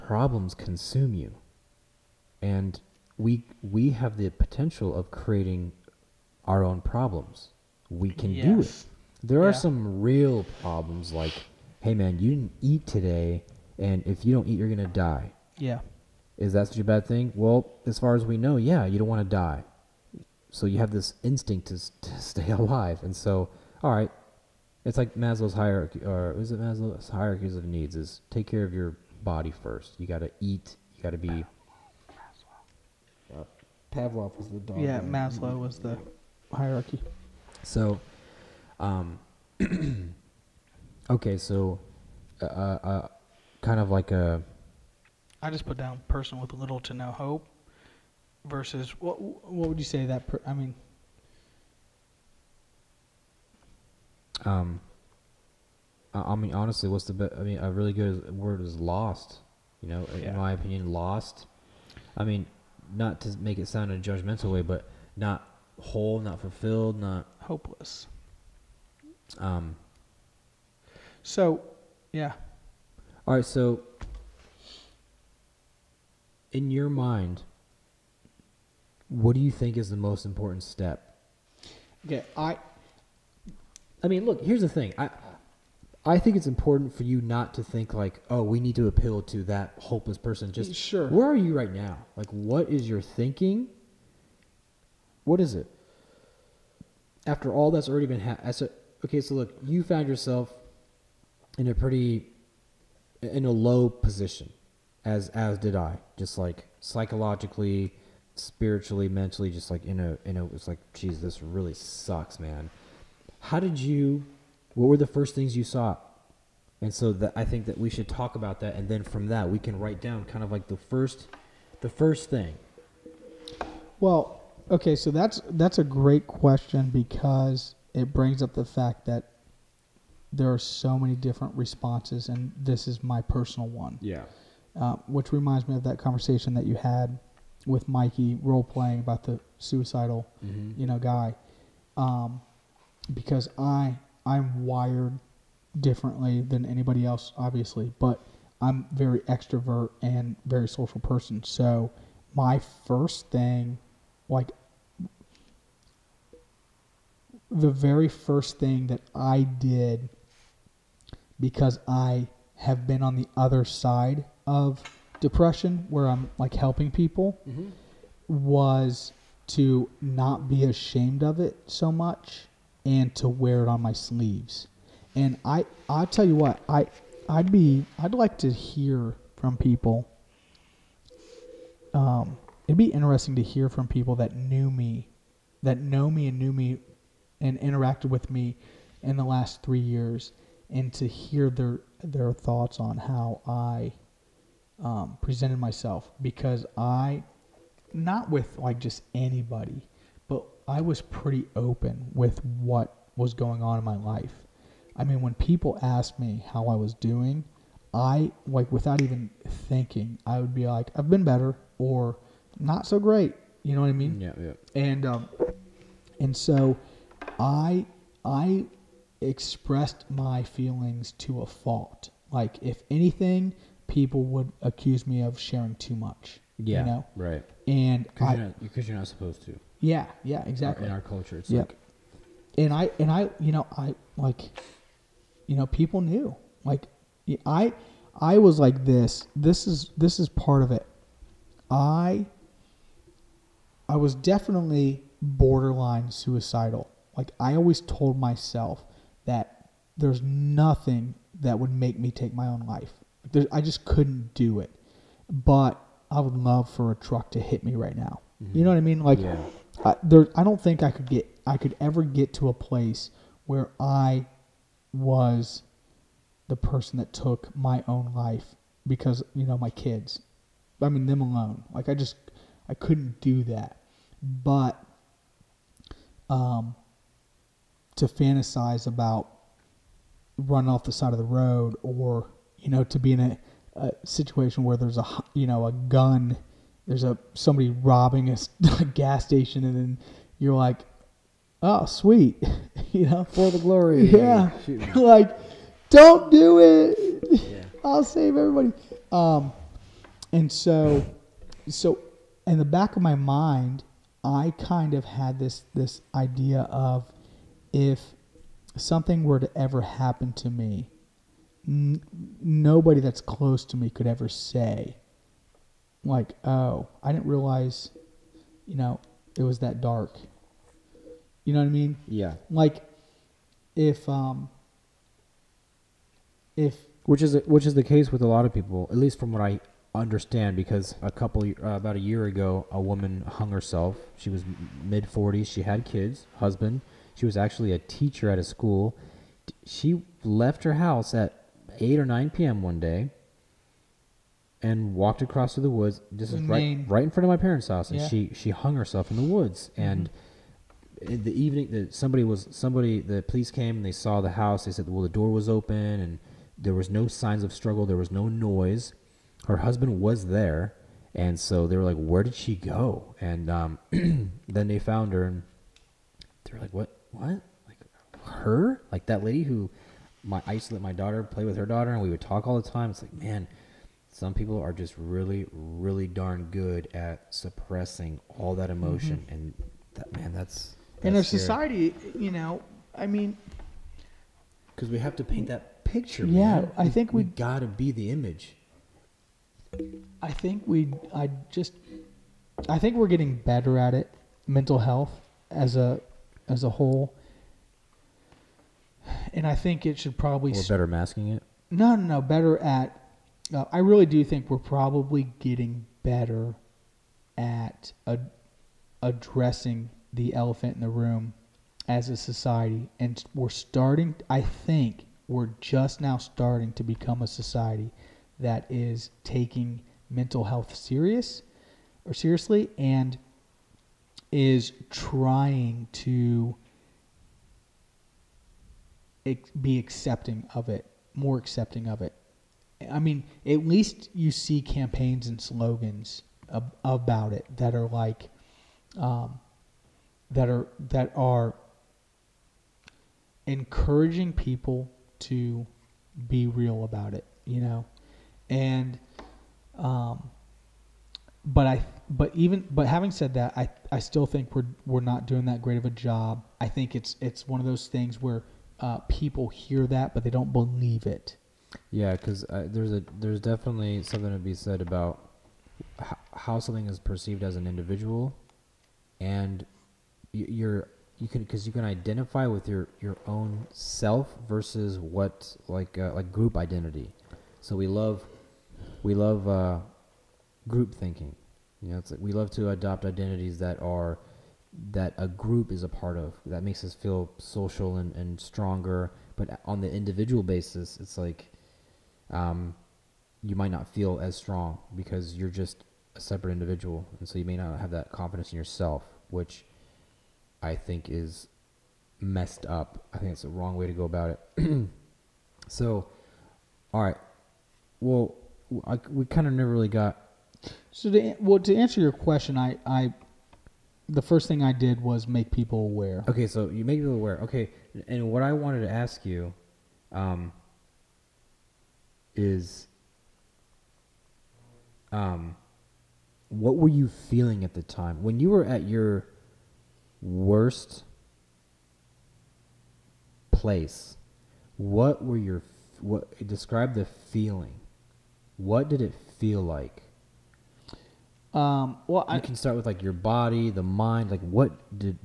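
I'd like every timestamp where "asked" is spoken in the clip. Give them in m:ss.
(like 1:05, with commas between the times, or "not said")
3:25.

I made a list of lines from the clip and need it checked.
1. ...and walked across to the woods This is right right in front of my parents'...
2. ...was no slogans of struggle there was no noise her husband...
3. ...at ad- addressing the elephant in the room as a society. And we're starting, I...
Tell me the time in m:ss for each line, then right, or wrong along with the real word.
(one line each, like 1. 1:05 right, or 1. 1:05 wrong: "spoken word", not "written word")
1. 5:44 right
2. 5:56 wrong: "signs", not "slogans"
3. 6:47 right.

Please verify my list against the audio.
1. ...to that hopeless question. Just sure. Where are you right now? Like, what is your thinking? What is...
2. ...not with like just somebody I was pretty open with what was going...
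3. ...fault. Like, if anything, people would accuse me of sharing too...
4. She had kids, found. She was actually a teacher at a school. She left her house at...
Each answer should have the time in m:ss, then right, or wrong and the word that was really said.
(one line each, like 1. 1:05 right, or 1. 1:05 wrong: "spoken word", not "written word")
1. 1:29 wrong: "person", not "question"
2. 3:17 wrong: "anybody", not "somebody"
3. 3:41 right
4. 5:35 wrong: "husband", not "found".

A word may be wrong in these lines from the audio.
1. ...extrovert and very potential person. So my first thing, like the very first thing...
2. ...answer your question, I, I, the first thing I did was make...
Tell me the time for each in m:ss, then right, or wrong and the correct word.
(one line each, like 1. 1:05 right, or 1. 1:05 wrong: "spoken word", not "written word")
1. 2:29 wrong: "social", not "potential"
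2. 8:31 right.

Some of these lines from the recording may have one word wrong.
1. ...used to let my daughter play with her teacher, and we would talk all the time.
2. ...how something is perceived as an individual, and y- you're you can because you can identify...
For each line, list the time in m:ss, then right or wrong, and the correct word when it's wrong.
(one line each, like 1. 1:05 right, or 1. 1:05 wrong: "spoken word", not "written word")
1. 6:10 wrong: "daughter", not "teacher"
2. 7:46 right.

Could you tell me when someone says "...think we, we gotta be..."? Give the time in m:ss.
6:26.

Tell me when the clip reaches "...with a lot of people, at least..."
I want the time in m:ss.
5:28.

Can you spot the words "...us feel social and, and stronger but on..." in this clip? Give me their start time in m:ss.
8:06.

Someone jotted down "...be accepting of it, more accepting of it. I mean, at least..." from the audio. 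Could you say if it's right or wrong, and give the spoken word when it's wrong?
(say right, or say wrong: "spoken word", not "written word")
right.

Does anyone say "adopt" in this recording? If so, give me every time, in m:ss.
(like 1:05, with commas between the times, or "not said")
8:02.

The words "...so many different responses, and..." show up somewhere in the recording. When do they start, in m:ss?
2:10.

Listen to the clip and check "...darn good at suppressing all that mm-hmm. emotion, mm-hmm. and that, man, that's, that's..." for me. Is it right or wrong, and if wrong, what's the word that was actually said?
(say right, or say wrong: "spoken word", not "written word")
right.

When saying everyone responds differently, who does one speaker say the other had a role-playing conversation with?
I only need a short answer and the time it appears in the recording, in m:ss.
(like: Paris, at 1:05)
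Mikey, at 2:17.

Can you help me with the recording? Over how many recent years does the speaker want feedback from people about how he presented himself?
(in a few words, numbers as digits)
3.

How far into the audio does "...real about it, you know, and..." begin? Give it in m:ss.
7:26.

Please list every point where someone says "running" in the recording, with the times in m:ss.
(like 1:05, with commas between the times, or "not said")
4:40.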